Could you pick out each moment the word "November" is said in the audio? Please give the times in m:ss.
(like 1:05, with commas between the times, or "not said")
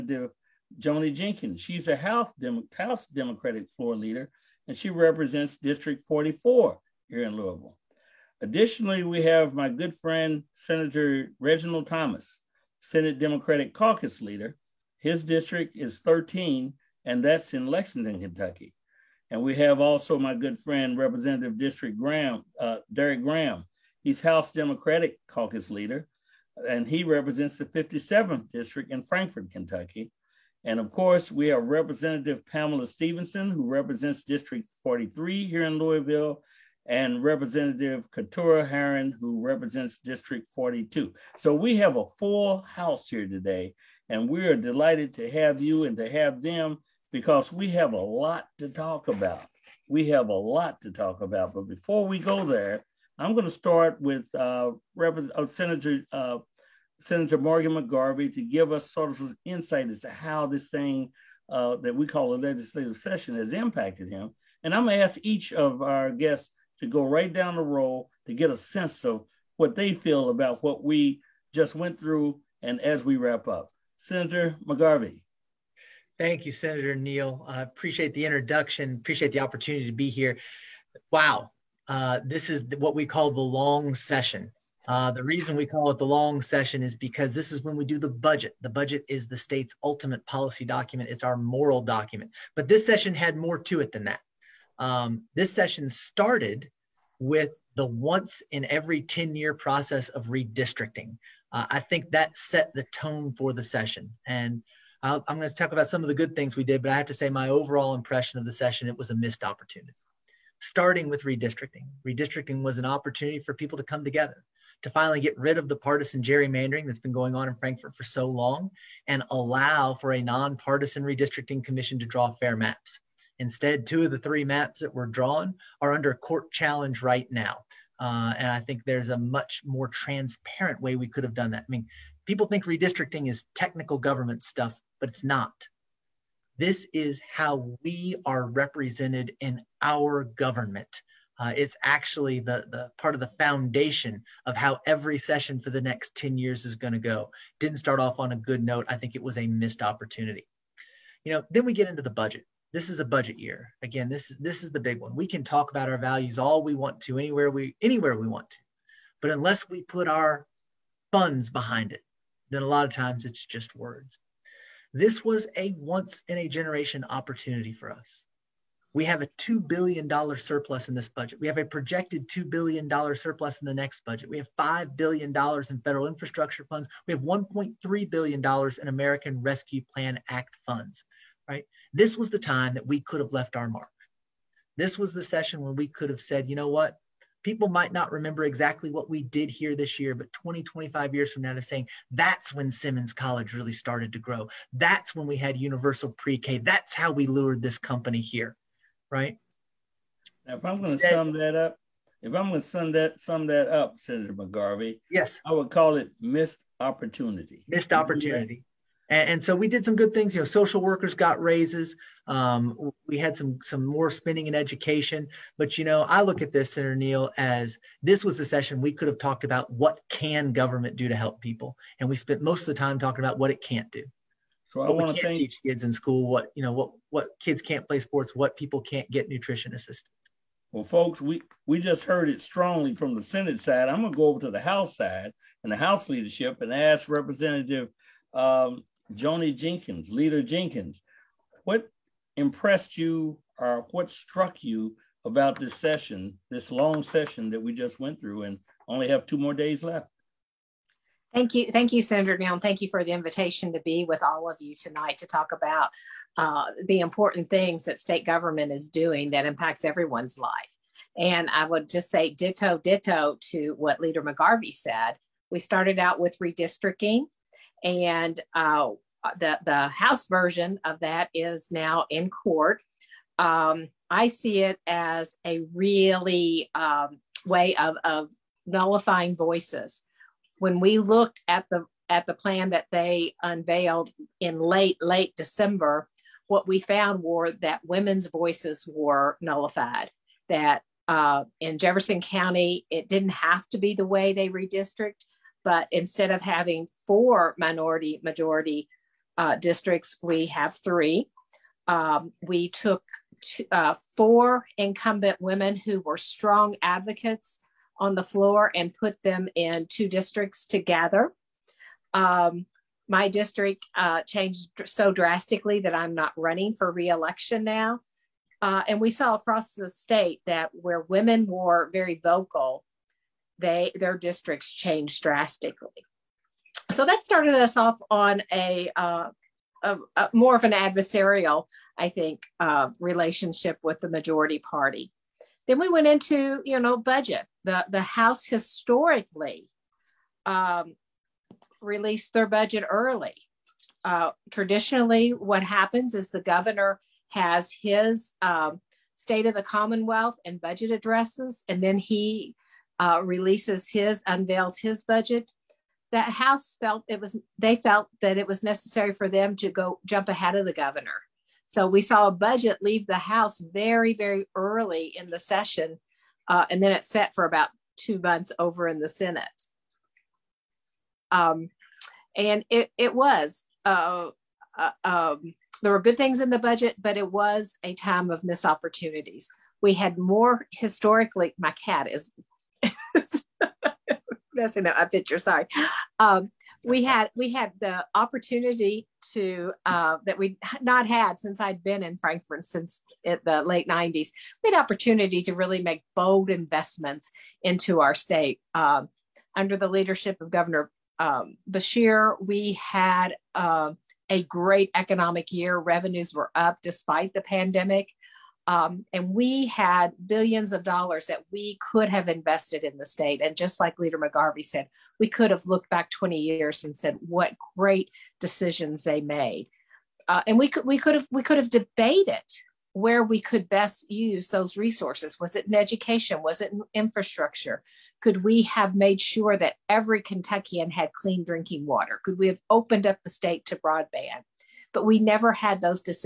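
not said.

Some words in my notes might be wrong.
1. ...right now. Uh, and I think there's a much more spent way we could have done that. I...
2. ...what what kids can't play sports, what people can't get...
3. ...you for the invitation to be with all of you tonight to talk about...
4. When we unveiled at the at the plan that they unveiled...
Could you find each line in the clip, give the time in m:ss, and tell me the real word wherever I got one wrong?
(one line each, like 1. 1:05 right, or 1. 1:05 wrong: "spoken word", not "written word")
1. 2:07 wrong: "transparent", not "spent"
2. 3:46 right
3. 4:12 right
4. 4:40 wrong: "looked", not "unveiled".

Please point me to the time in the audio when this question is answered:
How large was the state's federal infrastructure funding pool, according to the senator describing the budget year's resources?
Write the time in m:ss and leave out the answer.
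2:54.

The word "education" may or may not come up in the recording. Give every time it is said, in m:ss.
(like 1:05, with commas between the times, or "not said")
3:34, 7:05.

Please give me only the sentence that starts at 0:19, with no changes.
And we have also my good friend, Representative District Graham, uh, Derrick Graham.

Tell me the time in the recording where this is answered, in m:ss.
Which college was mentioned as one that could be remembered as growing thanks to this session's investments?
3:12.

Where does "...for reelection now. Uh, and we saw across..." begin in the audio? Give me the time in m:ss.
5:16.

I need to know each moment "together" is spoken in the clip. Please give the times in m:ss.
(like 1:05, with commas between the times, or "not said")
1:54, 5:10.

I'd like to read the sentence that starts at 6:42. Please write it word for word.
We had uh, a great economic year.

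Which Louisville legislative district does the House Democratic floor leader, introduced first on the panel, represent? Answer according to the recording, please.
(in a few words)
District 44.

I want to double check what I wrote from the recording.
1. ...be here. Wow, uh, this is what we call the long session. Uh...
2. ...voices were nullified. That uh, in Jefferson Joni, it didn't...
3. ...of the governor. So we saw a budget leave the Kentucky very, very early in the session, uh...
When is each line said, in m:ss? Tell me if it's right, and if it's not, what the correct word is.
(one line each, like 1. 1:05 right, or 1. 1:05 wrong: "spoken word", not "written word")
1. 1:19 right
2. 4:48 wrong: "County", not "Joni"
3. 6:00 wrong: "House", not "Kentucky".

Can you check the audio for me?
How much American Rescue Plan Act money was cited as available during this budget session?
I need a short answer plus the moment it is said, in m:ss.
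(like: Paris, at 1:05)
$1.3 billion, at 2:57.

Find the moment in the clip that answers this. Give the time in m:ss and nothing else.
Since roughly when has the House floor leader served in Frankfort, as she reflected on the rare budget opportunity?
6:33.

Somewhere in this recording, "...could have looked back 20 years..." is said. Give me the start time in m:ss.
6:55.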